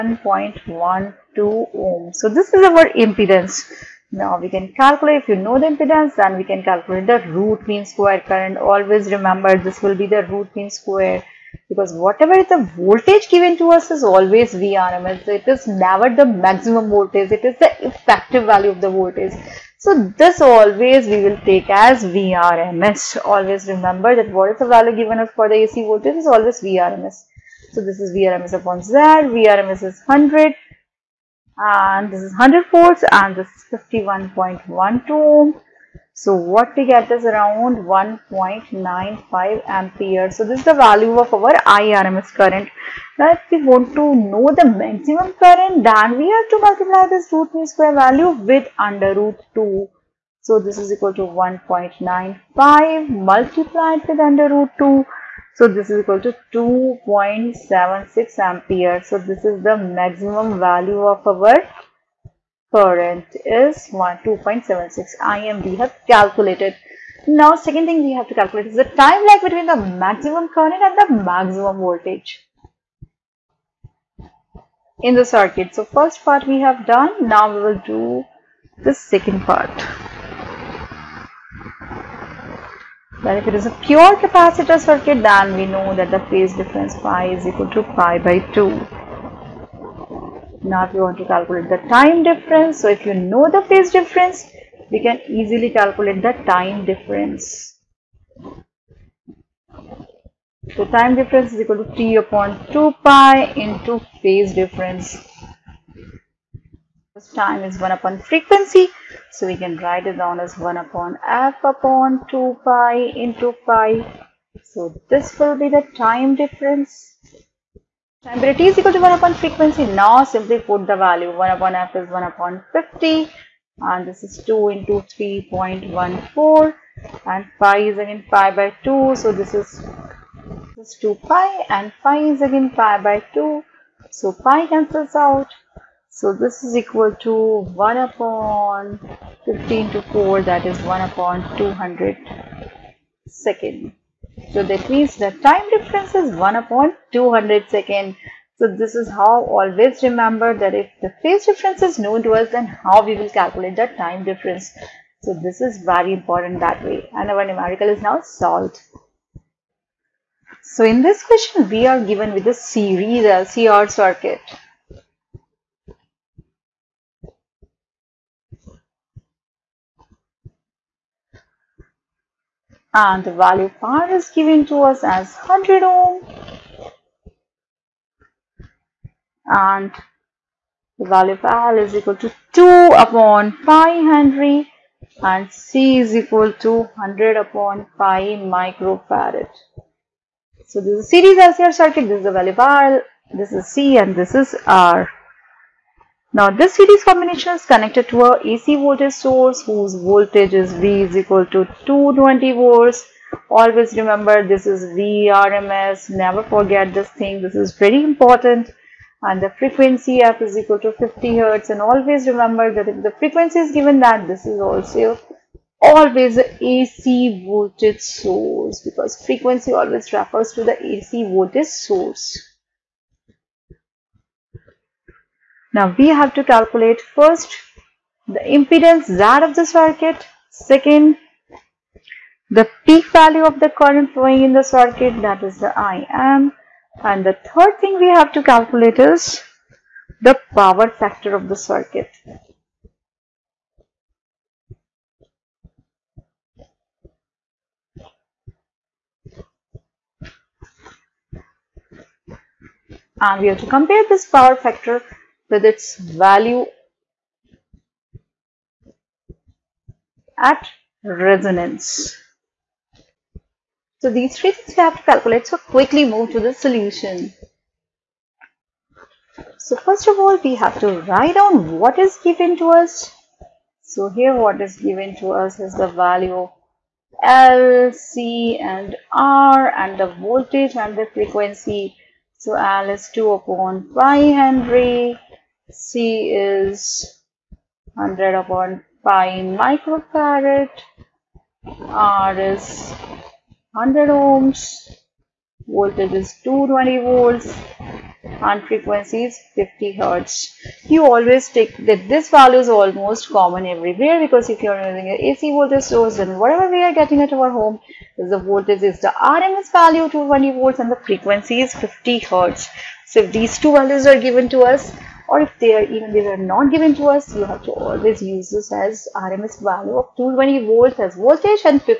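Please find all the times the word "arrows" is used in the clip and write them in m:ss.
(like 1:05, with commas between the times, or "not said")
not said.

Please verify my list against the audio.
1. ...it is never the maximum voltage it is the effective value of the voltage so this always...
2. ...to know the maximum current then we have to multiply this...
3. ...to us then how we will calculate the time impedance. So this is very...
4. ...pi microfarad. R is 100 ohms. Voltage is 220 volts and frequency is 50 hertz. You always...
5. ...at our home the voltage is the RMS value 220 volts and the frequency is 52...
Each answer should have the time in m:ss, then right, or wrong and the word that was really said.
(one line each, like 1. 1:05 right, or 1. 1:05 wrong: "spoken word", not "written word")
1. 0:15 right
2. 0:43 right
3. 2:32 wrong: "difference", not "impedance"
4. 4:49 right
5. 5:07 wrong: "50", not "52".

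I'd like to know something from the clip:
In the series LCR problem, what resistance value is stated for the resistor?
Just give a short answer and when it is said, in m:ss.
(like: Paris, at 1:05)
100 ohm, at 2:55.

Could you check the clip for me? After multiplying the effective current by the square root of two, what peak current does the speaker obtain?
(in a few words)
2.76 ampere.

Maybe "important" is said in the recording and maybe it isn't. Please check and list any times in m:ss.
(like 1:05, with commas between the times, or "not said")
2:36, 3:28.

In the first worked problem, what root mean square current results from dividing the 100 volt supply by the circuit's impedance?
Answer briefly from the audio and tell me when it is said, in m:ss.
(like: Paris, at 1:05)
1.95 ampere, at 0:37.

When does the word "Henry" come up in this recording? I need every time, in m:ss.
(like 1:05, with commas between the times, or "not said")
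3:04, 4:44.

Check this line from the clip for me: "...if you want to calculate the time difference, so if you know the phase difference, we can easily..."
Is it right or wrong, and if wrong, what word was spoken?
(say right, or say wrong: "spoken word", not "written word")
right.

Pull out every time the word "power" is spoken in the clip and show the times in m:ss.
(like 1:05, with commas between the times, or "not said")
4:00, 4:14.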